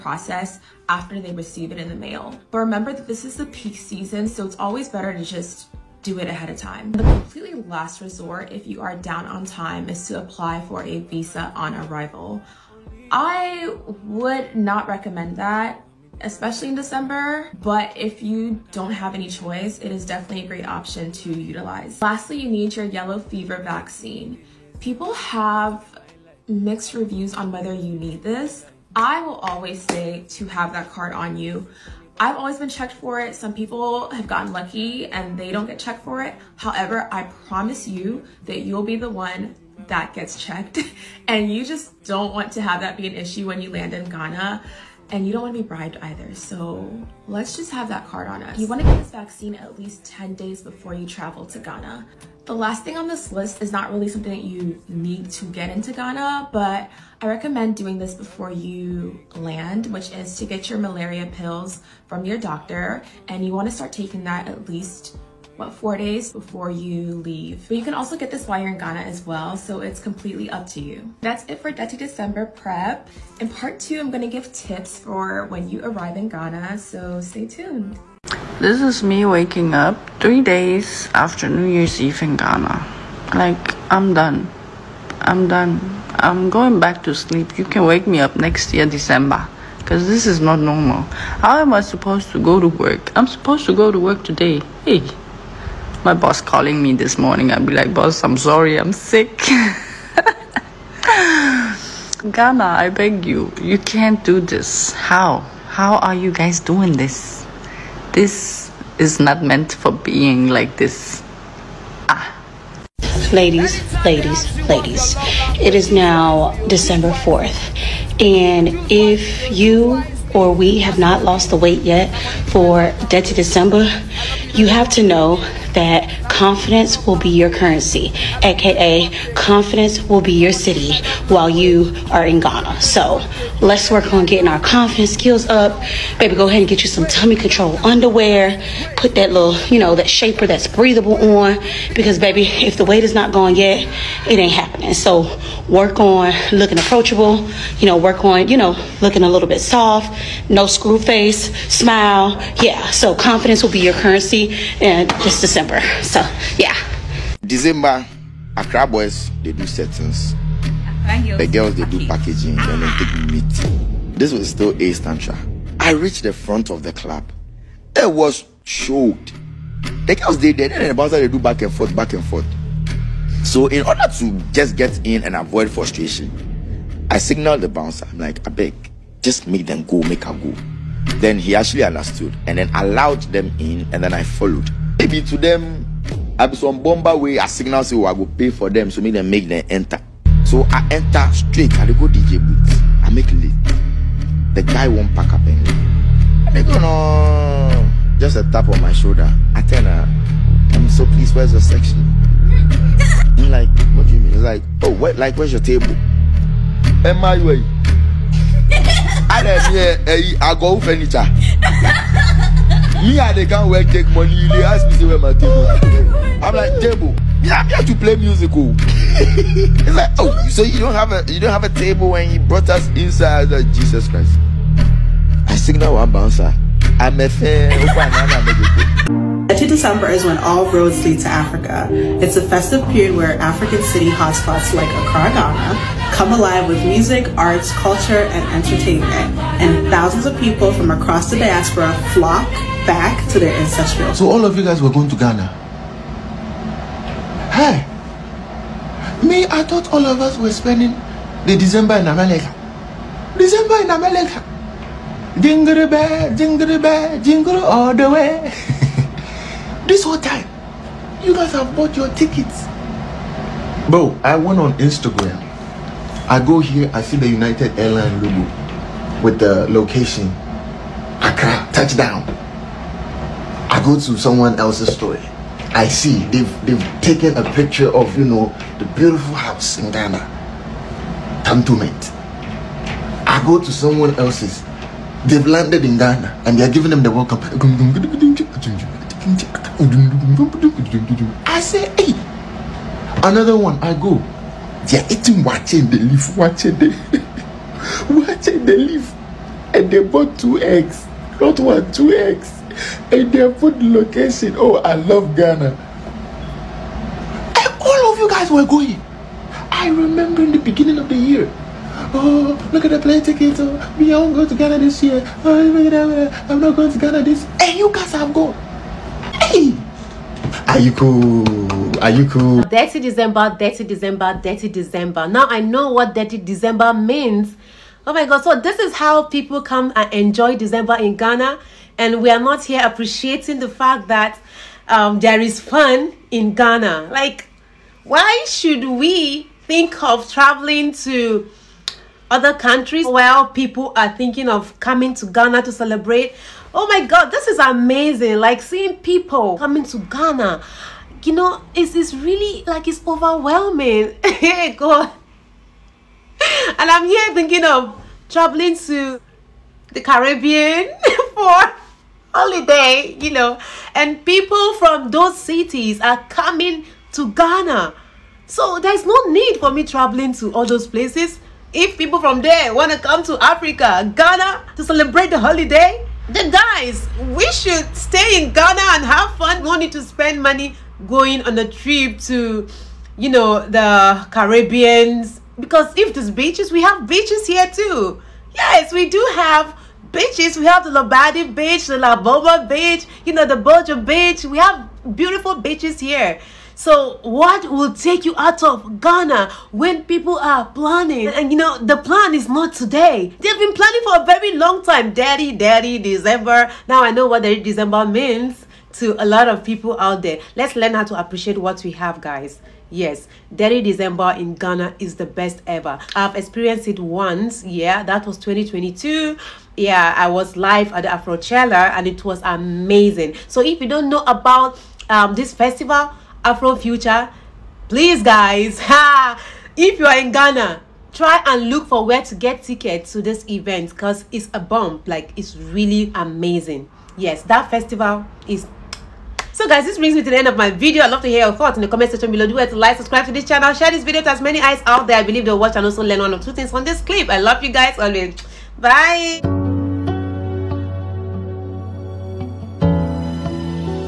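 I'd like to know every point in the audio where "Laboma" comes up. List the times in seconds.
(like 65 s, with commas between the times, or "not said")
391 s.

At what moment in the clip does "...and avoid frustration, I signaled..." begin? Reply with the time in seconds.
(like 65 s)
175 s.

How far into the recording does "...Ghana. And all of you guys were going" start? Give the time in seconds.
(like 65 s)
305 s.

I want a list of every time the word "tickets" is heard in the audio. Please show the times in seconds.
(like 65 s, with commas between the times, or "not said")
262 s, 313 s, 432 s.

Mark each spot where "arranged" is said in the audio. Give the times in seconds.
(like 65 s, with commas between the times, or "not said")
not said.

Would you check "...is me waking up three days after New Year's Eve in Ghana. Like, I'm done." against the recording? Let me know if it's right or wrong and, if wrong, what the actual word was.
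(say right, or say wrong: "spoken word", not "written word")
right.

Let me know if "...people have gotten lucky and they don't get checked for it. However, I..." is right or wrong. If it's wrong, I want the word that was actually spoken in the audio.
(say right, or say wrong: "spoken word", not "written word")
right.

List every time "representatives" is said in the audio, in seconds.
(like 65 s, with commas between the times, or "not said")
not said.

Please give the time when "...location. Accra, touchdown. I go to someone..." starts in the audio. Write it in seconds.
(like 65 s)
269 s.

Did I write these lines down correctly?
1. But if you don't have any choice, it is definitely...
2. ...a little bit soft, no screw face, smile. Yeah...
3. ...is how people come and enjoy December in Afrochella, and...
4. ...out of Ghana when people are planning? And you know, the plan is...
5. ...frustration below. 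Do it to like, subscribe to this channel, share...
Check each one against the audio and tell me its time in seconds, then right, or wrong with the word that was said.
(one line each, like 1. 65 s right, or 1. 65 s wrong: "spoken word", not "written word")
1. 17 s right
2. 149 s right
3. 328 s wrong: "Ghana", not "Afrochella"
4. 398 s right
5. 442 s wrong: "section", not "frustration".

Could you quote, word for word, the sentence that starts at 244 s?
So all of you guys were going to Ghana?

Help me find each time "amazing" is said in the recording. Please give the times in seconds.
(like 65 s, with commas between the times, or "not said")
347 s, 422 s, 436 s.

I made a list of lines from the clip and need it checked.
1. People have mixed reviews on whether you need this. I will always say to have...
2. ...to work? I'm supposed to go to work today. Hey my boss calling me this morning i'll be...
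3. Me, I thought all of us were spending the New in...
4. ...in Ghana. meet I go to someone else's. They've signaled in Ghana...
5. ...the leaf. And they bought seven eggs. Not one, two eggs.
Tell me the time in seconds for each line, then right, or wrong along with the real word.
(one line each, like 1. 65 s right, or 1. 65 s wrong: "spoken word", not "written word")
1. 24 s right
2. 92 s right
3. 249 s wrong: "December", not "New"
4. 279 s wrong: "landed", not "signaled"
5. 298 s wrong: "two", not "seven".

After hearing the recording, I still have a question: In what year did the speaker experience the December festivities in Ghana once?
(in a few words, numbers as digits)
2022.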